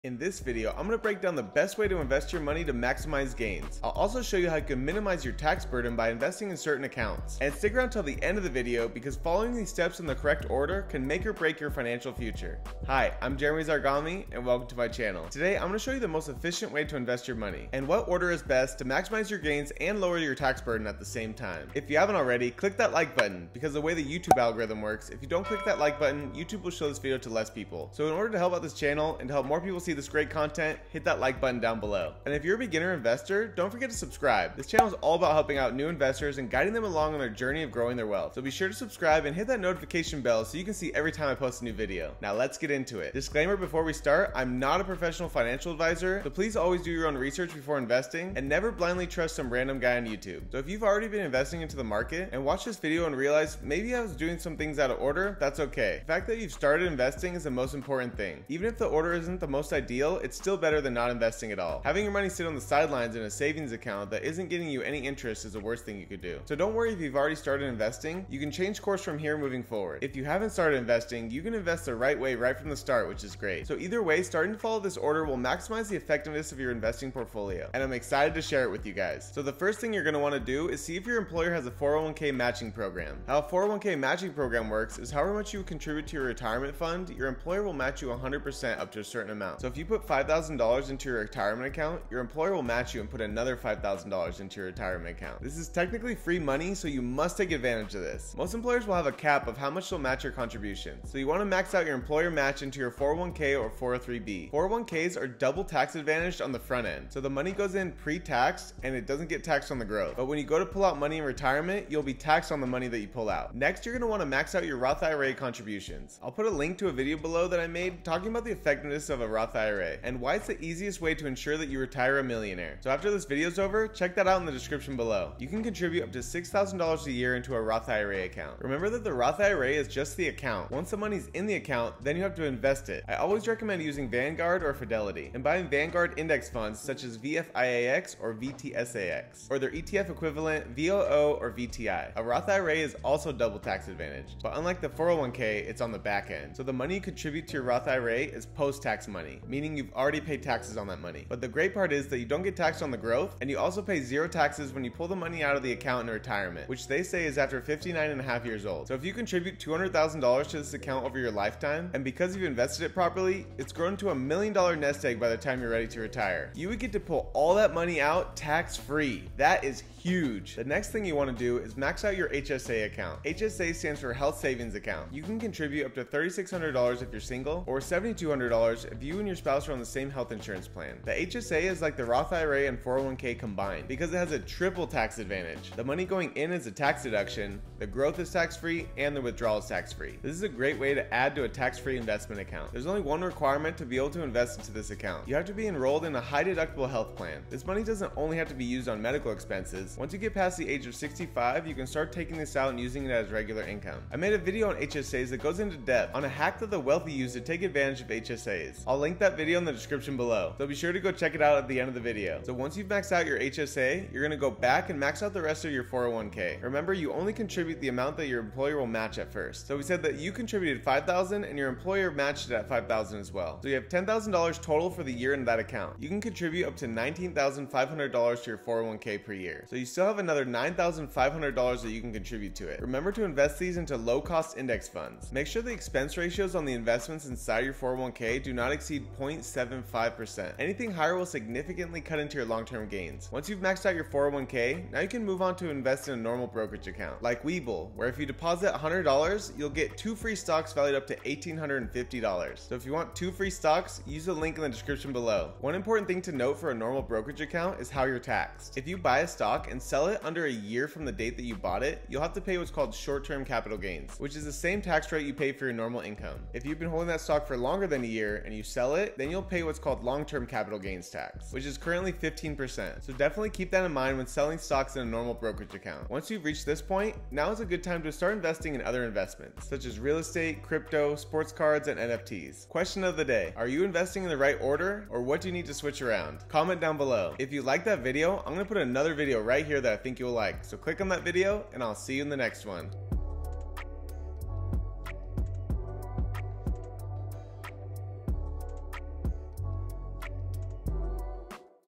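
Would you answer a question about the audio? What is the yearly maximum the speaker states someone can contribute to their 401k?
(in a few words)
$19,500.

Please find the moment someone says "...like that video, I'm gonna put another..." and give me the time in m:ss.
4:47.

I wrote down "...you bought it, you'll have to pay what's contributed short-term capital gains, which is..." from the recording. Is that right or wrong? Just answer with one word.
wrong.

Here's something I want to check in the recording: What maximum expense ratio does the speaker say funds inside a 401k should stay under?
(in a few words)
0.75%.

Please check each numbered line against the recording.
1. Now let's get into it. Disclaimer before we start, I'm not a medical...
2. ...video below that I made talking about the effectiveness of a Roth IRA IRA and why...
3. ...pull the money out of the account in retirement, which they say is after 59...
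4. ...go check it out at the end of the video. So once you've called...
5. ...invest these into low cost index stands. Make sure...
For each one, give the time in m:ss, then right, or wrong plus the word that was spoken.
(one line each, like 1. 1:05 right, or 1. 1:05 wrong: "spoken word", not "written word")
1. 0:42 wrong: "professional", not "medical"
2. 1:56 right
3. 2:34 right
4. 3:30 wrong: "maxed", not "called"
5. 3:53 wrong: "funds", not "stands".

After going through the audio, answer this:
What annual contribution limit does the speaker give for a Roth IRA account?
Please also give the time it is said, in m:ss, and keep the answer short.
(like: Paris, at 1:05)
$6,000, at 2:06.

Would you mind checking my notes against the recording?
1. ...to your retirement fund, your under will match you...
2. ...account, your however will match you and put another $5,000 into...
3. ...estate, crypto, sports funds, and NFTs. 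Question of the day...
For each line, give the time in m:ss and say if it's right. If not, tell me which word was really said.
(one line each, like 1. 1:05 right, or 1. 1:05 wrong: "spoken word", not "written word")
1. 1:26 wrong: "employer", not "under"
2. 1:31 wrong: "employer", not "however"
3. 4:40 wrong: "cards", not "funds".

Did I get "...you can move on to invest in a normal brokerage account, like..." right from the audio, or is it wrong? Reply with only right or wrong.
right.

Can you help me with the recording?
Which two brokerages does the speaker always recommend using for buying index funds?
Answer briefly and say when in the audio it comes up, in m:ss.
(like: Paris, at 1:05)
Vanguard or Fidelity, at 2:14.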